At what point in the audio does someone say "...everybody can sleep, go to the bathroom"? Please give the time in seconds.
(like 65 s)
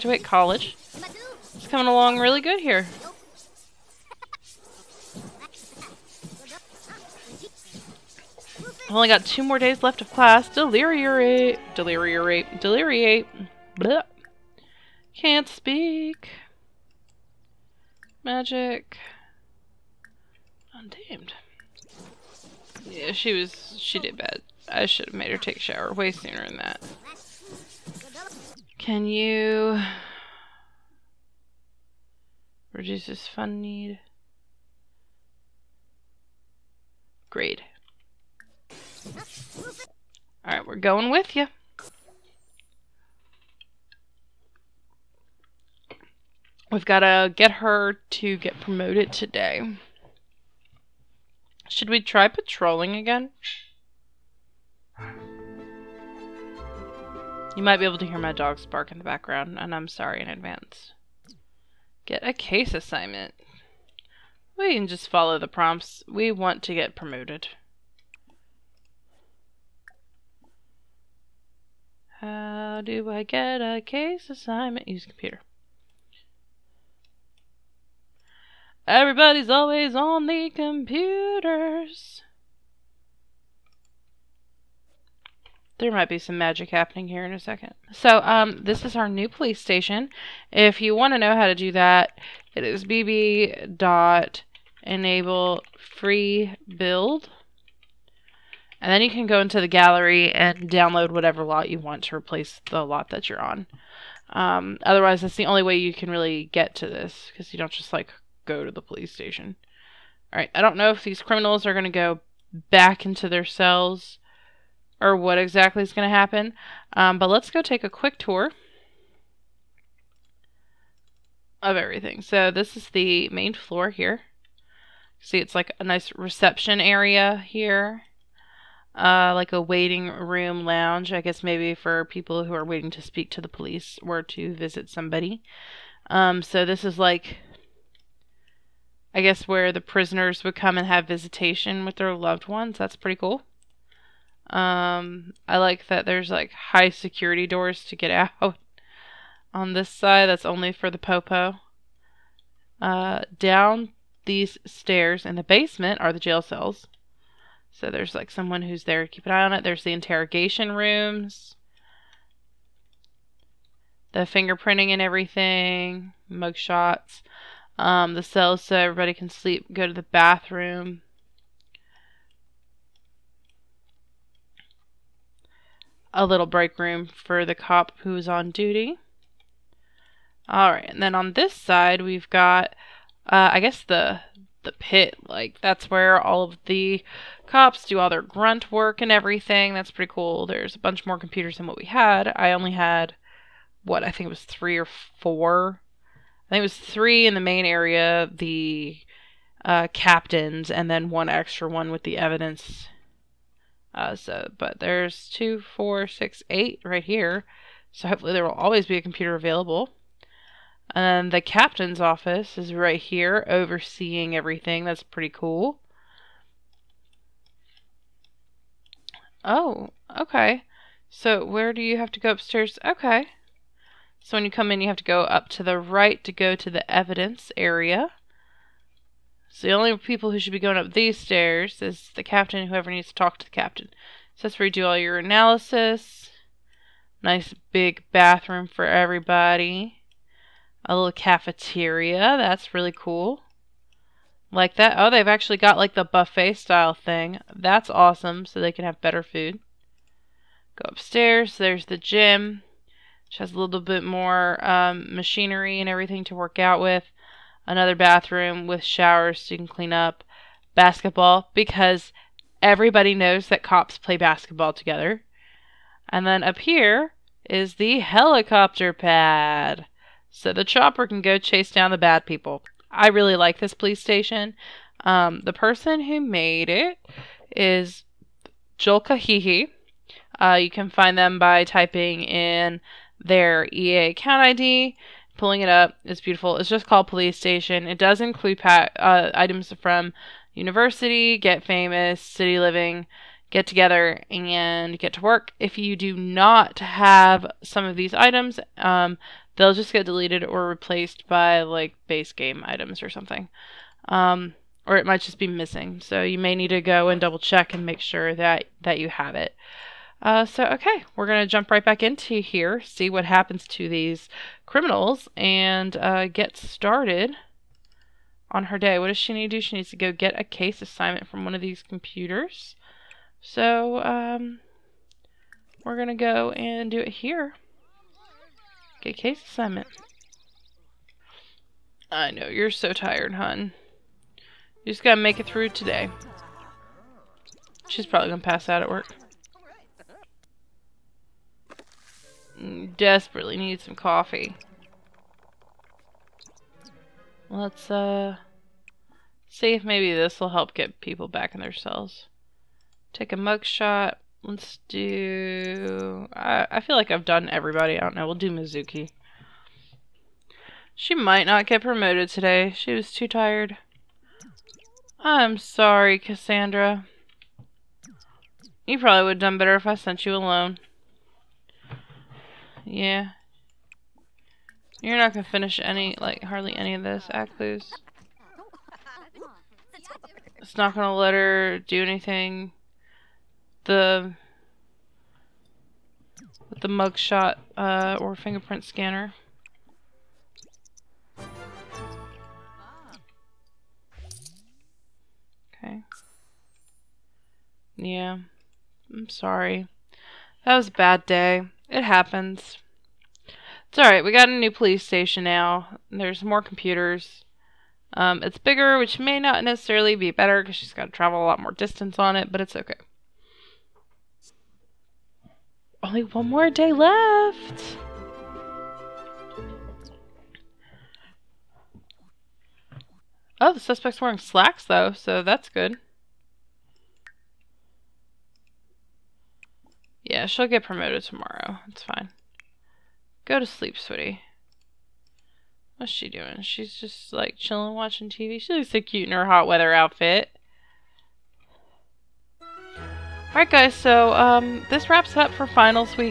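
168 s.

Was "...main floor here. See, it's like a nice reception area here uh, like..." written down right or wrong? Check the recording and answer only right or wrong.
right.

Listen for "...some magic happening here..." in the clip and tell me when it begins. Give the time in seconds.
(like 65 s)
86 s.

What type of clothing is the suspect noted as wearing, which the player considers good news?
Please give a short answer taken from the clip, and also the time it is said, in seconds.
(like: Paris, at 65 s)
Slacks, at 424 s.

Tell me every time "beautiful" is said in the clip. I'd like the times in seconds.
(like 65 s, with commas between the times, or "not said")
286 s.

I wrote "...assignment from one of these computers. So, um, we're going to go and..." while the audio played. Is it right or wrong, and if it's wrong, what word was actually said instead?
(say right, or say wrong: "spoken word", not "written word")
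right.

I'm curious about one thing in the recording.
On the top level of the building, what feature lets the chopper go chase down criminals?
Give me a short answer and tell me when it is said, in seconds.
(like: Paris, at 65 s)
Helicopter pad, at 267 s.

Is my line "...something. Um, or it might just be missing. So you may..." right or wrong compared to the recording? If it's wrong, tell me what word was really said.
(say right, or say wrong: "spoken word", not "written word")
right.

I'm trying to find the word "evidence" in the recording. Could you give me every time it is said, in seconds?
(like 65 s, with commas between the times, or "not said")
202 s, 226 s.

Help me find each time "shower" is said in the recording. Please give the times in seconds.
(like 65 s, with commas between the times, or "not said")
25 s, 258 s.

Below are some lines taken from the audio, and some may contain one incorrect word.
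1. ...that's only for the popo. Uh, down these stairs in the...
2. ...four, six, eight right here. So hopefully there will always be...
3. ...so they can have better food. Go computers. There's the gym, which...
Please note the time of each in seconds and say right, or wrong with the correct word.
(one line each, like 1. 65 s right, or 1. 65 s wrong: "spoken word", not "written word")
1. 150 s right
2. 205 s right
3. 248 s wrong: "upstairs", not "computers".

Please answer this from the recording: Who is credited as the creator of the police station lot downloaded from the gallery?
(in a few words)
Joel Kahihi.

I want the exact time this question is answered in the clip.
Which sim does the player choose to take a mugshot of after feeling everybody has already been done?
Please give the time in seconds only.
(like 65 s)
358 s.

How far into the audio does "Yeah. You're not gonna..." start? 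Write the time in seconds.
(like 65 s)
372 s.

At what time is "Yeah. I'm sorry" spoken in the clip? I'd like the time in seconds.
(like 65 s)
397 s.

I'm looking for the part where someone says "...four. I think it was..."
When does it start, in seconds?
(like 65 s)
195 s.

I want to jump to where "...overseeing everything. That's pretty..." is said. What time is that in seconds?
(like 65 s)
213 s.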